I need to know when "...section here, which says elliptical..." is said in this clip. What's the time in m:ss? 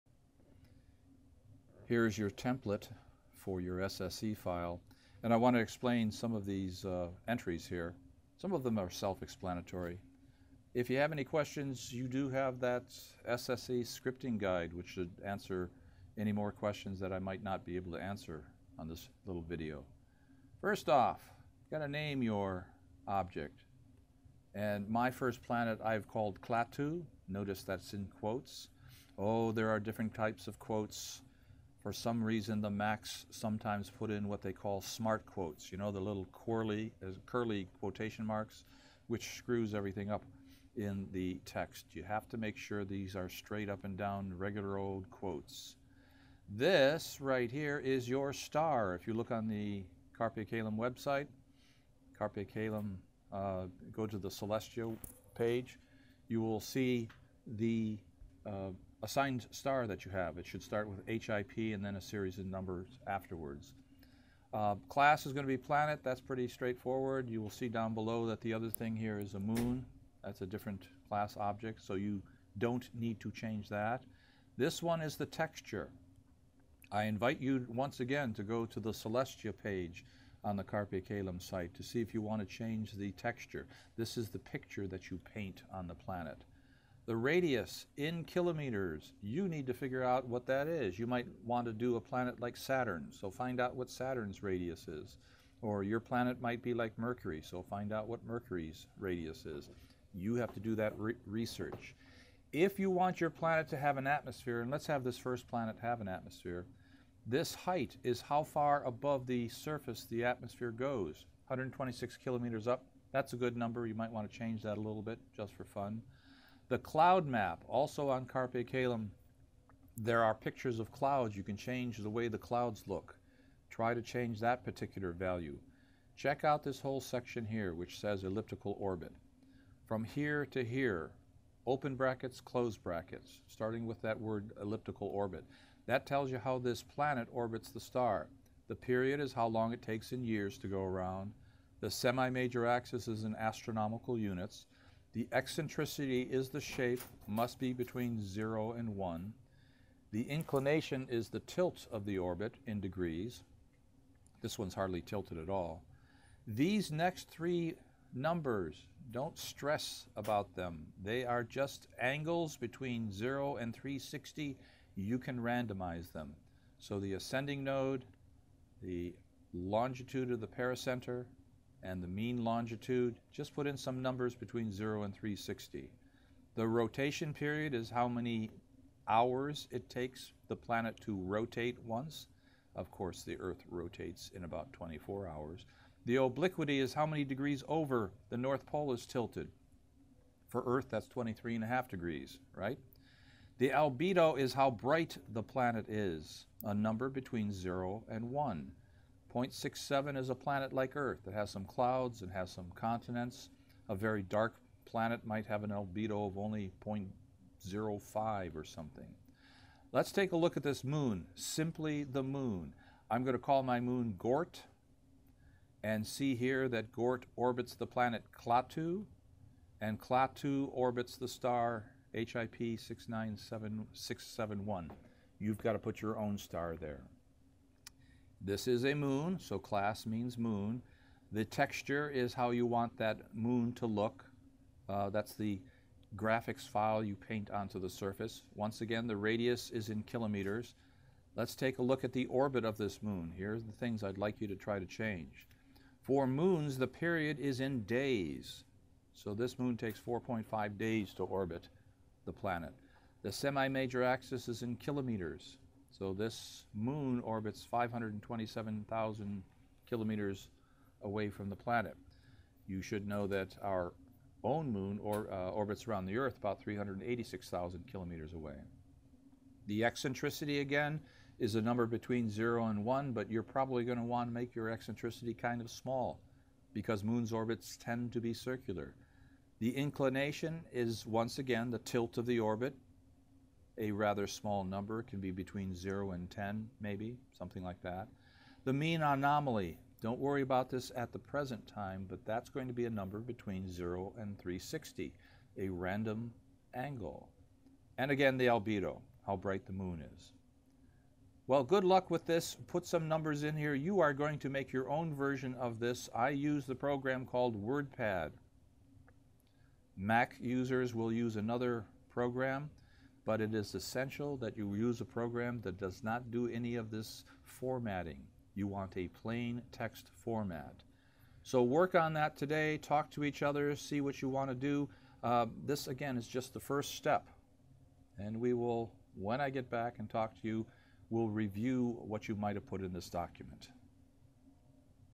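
2:07.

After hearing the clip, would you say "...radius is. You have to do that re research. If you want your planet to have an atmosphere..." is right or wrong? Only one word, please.
right.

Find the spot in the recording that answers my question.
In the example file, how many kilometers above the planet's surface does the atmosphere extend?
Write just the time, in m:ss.
1:51.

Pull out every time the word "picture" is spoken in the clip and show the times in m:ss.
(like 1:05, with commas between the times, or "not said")
1:24, 2:00.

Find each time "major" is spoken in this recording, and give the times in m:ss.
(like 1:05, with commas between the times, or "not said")
2:21, 4:13.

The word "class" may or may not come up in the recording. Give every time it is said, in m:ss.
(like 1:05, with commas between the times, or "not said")
1:04, 1:11, 3:49.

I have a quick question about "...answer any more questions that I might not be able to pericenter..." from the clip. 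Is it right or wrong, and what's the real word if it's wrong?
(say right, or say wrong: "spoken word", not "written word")
wrong: "answer", not "pericenter".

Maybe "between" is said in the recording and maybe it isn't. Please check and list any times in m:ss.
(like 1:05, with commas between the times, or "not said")
2:27, 2:42, 2:54, 3:17, 4:31, 4:45, 4:53.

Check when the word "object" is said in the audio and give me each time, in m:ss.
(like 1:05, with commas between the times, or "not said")
0:23, 1:11.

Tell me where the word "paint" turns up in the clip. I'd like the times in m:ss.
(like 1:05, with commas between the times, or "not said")
1:25, 3:57.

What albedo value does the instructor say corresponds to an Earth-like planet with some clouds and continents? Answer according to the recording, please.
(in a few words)
0.67.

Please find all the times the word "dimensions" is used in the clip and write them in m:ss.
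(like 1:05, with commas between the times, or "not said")
not said.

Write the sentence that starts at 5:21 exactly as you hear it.
So work on that today, talk to each other, see what you want to do.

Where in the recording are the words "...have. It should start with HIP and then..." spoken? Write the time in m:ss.
1:00.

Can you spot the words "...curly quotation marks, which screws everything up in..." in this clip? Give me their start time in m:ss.
0:37.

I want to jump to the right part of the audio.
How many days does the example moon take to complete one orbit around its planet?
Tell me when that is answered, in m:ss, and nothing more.
4:10.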